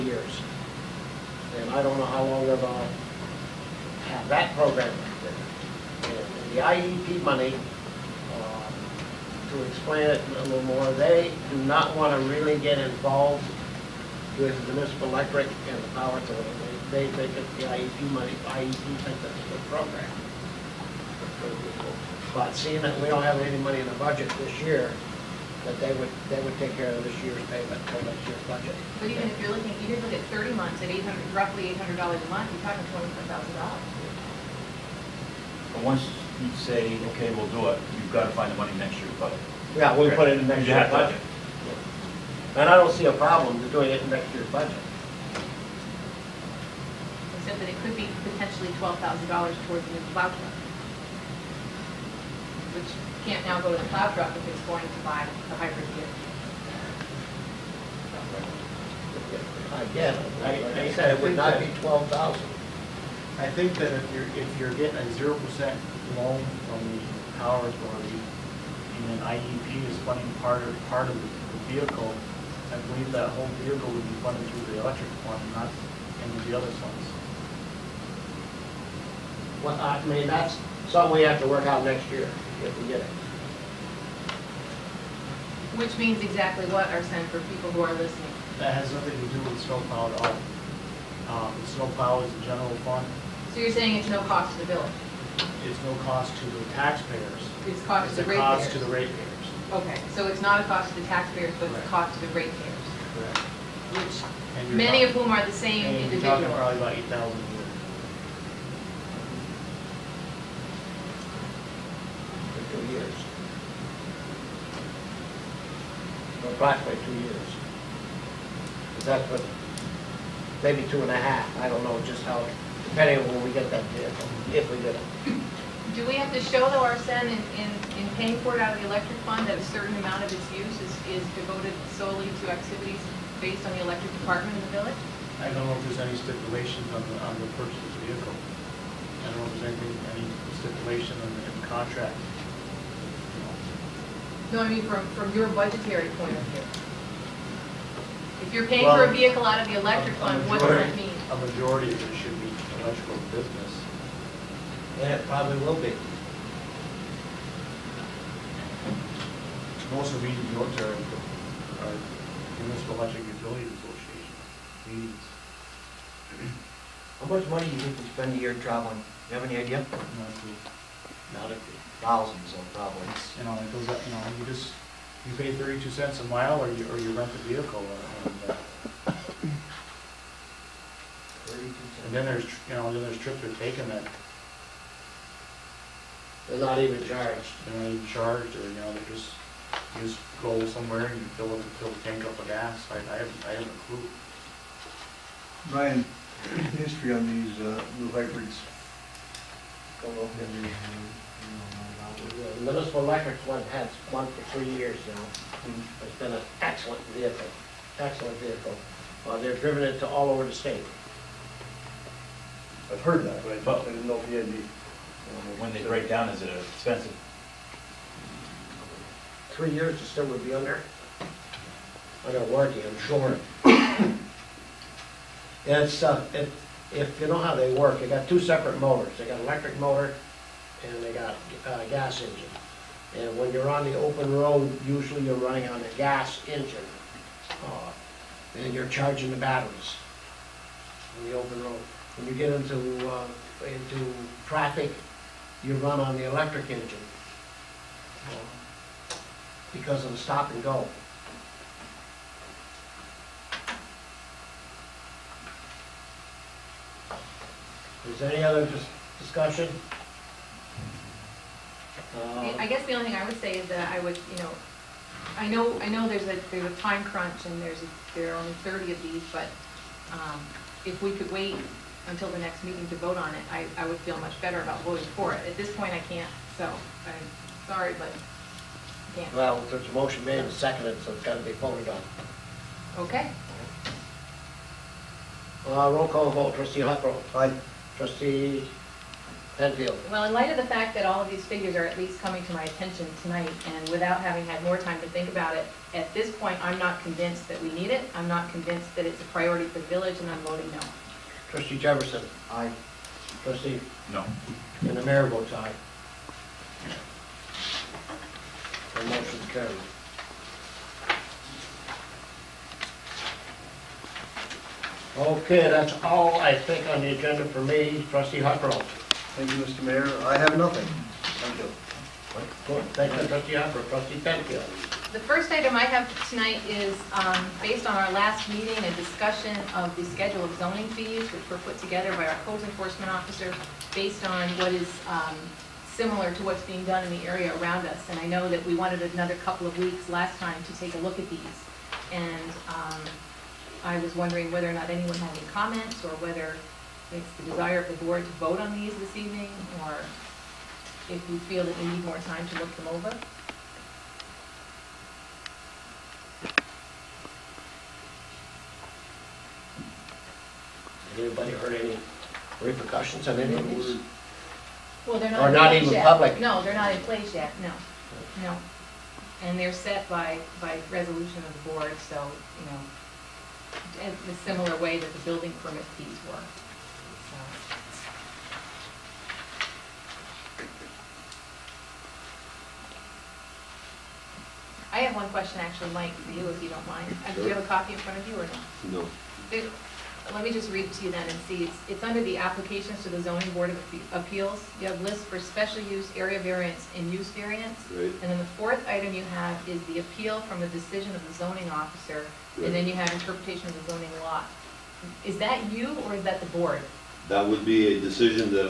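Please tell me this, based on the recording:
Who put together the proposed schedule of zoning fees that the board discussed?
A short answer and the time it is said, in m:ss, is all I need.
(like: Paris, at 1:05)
Code enforcement officer, at 5:32.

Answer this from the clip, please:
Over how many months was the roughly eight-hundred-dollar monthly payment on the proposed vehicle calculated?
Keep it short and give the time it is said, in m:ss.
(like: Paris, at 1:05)
30, at 0:30.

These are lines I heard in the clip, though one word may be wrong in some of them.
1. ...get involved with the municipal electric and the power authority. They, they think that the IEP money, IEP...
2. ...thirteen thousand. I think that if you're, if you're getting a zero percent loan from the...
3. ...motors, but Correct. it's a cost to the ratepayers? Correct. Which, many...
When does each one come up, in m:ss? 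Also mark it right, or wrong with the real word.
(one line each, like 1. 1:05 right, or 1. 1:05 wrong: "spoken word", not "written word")
1. 0:12 right
2. 1:01 wrong: "twelve", not "thirteen"
3. 1:41 wrong: "taxpayers", not "motors".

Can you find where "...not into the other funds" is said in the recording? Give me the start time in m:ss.
1:15.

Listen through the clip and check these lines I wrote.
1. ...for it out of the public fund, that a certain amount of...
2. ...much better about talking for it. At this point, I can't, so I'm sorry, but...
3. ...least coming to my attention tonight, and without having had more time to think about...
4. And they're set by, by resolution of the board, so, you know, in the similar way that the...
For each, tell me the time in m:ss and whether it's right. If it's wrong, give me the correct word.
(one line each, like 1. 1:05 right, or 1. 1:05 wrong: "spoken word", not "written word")
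1. 2:08 wrong: "electric", not "public"
2. 4:34 wrong: "voting", not "talking"
3. 4:51 right
4. 6:09 right.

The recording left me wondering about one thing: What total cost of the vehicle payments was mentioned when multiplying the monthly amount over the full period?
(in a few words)
$24,000.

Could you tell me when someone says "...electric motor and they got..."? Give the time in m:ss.
3:49.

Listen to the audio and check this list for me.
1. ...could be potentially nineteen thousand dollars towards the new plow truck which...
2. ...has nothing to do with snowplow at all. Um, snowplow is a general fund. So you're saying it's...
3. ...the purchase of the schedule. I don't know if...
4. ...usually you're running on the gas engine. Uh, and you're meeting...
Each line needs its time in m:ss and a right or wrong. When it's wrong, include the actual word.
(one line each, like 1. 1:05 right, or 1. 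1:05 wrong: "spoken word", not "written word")
1. 0:47 wrong: "twelve", not "nineteen"
2. 1:28 right
3. 2:17 wrong: "vehicle", not "schedule"
4. 3:54 wrong: "charging", not "meeting".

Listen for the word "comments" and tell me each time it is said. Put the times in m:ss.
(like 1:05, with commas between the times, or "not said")
5:45.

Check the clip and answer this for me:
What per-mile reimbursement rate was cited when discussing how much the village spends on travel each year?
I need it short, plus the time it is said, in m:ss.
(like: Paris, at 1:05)
32 cents, at 2:55.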